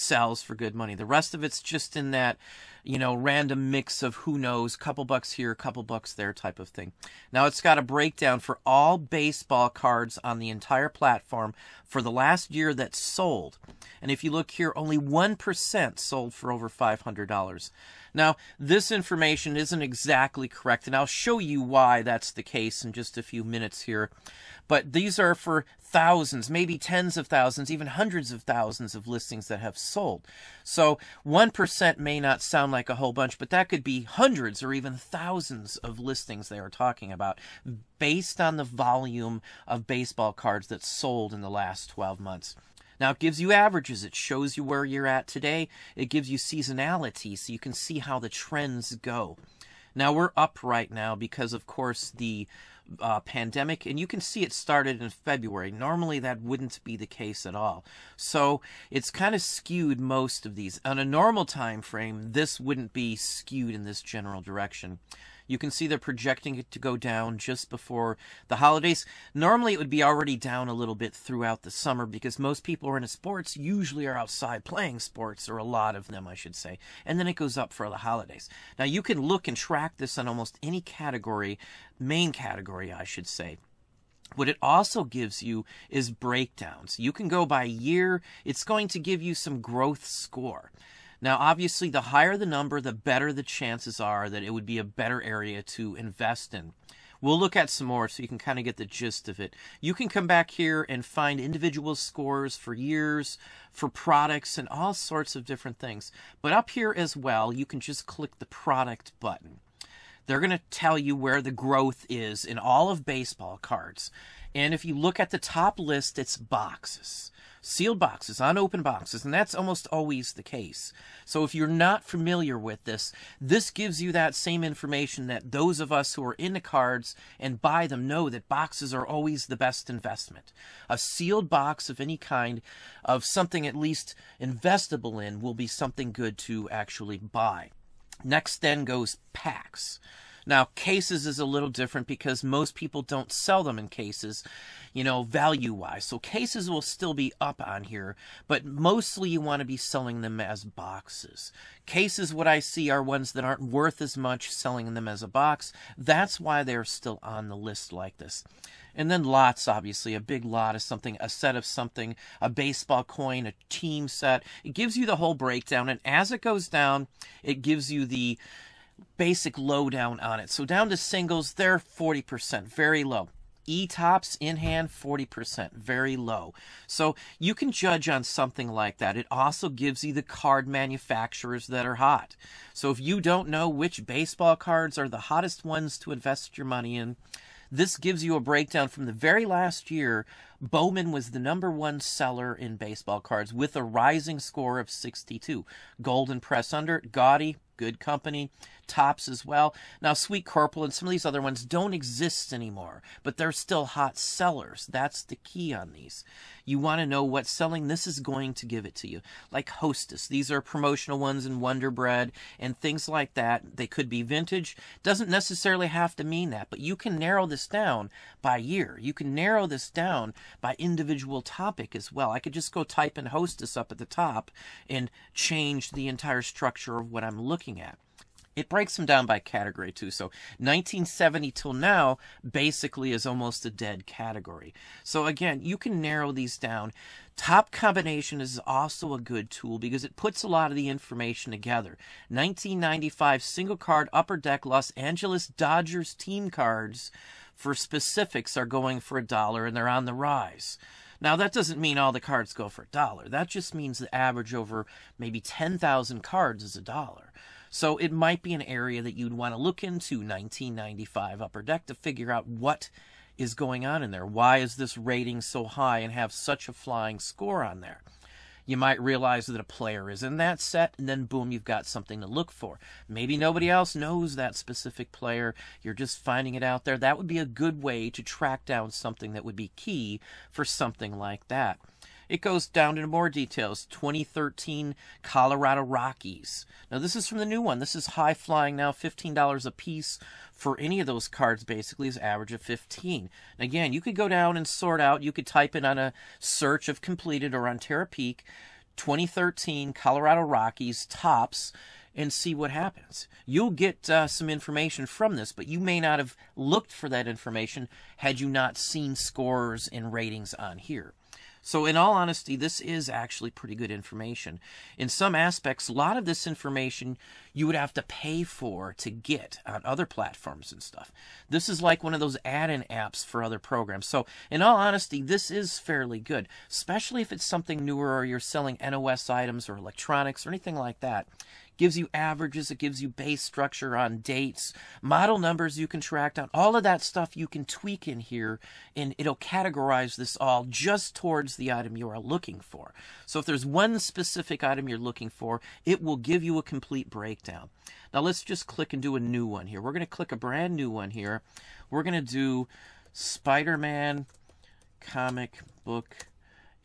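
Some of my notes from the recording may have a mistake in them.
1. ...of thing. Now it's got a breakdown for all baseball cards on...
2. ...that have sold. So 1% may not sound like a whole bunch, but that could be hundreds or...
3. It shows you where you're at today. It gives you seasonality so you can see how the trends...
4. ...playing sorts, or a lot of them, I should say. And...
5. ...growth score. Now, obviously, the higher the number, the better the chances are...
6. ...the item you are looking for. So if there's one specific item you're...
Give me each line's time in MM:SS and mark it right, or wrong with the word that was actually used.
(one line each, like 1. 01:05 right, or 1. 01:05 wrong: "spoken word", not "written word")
1. 00:06 right
2. 00:29 right
3. 00:44 right
4. 01:14 wrong: "sports", not "sorts"
5. 01:29 right
6. 05:41 right.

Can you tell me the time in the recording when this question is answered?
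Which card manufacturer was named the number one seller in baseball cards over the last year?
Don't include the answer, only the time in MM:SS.
03:10.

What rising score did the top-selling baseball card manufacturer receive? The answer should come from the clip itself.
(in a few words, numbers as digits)
62.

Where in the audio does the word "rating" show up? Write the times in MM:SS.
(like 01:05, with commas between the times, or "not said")
04:24, 05:10.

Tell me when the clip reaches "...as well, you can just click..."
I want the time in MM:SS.
01:46.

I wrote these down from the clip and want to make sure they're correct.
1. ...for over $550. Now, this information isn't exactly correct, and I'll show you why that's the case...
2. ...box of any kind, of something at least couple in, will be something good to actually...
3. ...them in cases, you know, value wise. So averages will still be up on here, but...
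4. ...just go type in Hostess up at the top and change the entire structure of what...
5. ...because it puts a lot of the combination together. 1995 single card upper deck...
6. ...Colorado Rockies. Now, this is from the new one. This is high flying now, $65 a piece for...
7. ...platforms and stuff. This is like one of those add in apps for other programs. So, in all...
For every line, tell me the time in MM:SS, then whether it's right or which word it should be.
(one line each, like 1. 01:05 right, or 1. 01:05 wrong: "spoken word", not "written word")
1. 00:16 wrong: "500", not "550"
2. 02:11 wrong: "investable", not "couple"
3. 02:23 wrong: "cases", not "averages"
4. 03:42 right
5. 03:59 wrong: "information", not "combination"
6. 04:45 wrong: "15", not "65"
7. 05:20 right.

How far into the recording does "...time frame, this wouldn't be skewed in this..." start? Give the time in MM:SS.
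01:01.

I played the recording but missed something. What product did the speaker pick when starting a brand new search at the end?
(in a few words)
Spider-Man comic book.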